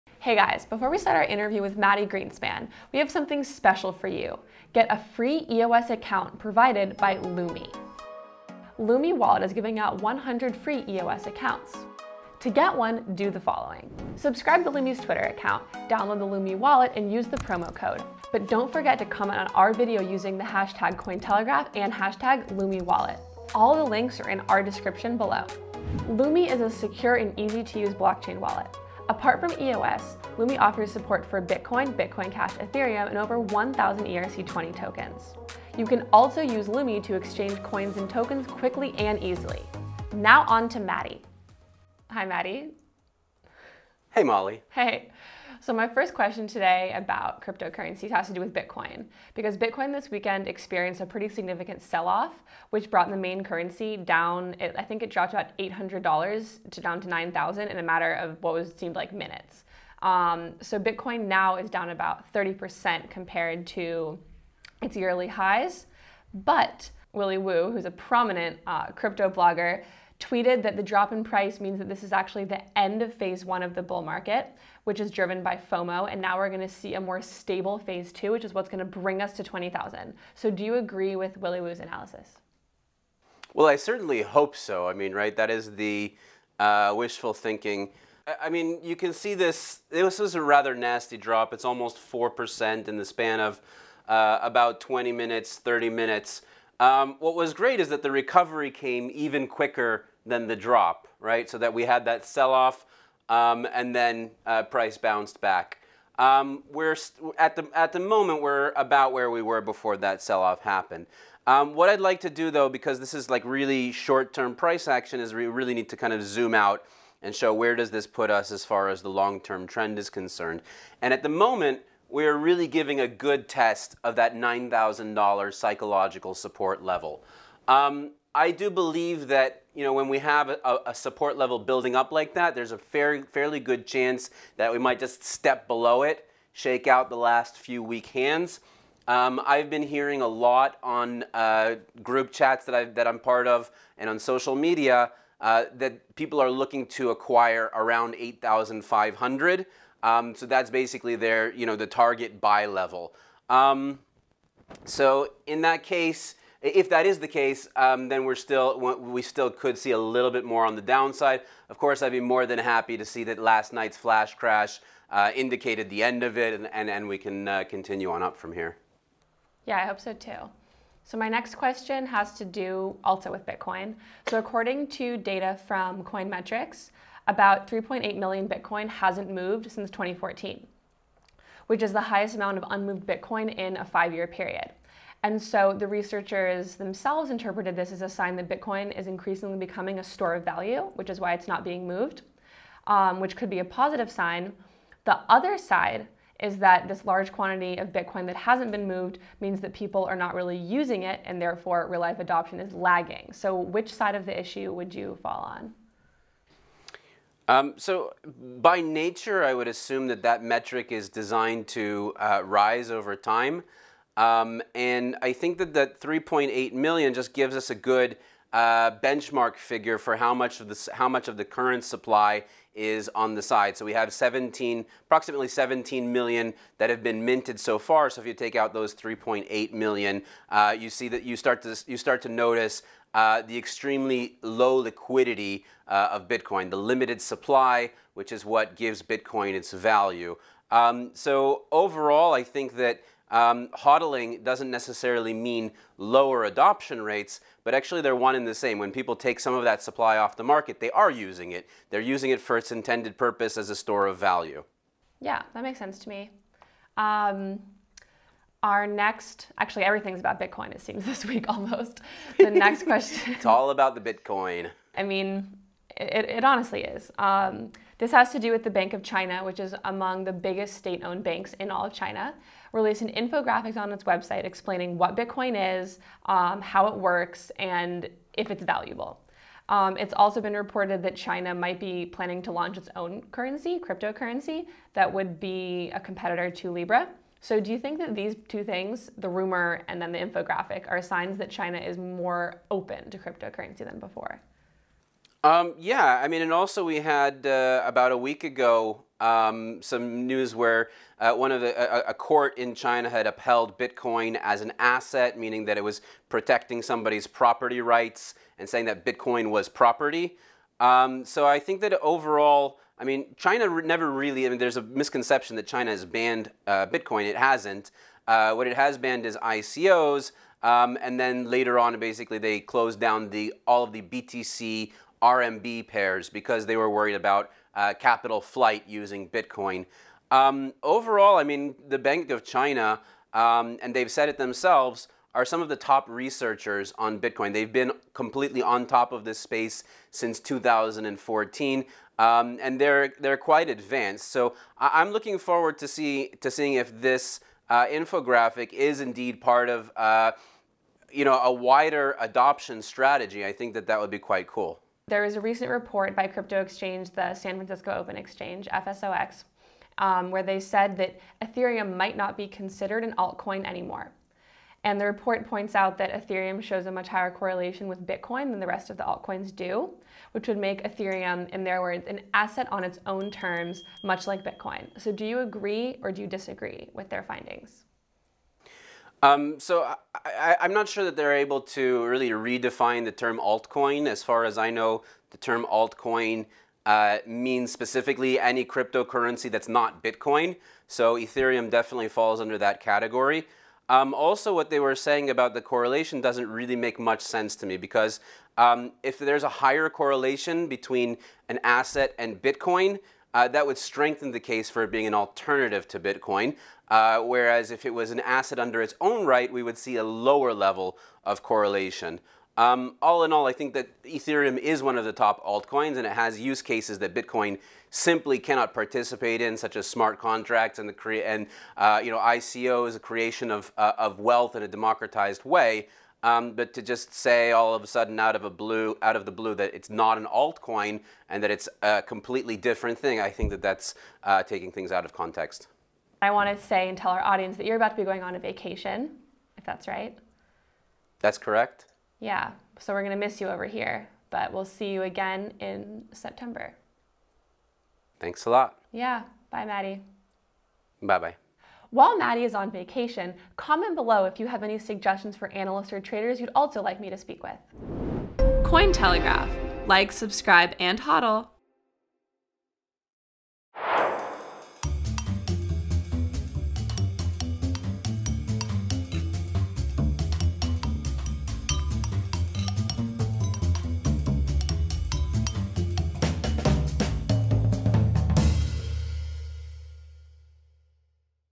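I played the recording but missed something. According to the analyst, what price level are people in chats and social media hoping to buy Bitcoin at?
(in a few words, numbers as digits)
8,500.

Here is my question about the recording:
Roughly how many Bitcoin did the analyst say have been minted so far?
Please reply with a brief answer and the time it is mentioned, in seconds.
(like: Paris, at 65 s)
17 million, at 225 s.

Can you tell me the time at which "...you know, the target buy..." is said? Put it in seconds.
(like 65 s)
151 s.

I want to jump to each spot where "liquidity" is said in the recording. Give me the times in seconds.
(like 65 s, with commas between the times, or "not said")
234 s.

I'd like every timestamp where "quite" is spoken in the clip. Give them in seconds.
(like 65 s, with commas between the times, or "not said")
343 s, 354 s.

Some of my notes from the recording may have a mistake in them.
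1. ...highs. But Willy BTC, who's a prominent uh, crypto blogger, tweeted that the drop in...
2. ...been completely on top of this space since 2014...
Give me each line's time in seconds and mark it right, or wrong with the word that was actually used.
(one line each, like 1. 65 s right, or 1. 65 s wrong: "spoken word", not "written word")
1. 65 s wrong: "Woo", not "BTC"
2. 337 s right.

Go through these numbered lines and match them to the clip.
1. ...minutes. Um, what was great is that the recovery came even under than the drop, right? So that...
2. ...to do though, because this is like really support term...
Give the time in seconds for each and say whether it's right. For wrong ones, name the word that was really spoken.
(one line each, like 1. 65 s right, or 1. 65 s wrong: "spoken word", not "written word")
1. 95 s wrong: "quicker", not "under"
2. 112 s wrong: "short", not "support".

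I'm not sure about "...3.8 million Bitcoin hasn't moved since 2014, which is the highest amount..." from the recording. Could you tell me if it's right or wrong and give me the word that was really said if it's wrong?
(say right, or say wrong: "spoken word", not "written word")
right.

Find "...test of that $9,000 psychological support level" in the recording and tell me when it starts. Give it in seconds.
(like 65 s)
123 s.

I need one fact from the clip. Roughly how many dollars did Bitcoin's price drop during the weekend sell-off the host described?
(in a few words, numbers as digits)
$800.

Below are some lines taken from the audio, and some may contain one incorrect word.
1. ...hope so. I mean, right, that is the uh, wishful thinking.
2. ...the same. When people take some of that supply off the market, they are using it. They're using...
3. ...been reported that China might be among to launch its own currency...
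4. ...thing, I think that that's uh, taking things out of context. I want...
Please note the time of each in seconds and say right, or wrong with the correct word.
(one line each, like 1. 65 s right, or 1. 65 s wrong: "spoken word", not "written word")
1. 84 s right
2. 248 s right
3. 280 s wrong: "planning", not "among"
4. 432 s right.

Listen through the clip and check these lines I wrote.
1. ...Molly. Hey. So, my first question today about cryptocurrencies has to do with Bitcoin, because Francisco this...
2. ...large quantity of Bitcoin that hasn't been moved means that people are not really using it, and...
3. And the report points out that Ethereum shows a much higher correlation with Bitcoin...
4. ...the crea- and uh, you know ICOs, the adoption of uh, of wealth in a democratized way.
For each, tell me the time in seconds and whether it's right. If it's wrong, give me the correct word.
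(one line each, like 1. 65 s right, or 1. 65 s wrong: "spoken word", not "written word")
1. 44 s wrong: "Bitcoin", not "Francisco"
2. 197 s right
3. 364 s right
4. 420 s wrong: "creation", not "adoption".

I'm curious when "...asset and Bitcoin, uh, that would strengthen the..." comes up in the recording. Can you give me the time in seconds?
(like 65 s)
401 s.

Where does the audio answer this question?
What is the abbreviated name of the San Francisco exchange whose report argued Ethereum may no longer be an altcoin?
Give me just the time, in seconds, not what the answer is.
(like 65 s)
358 s.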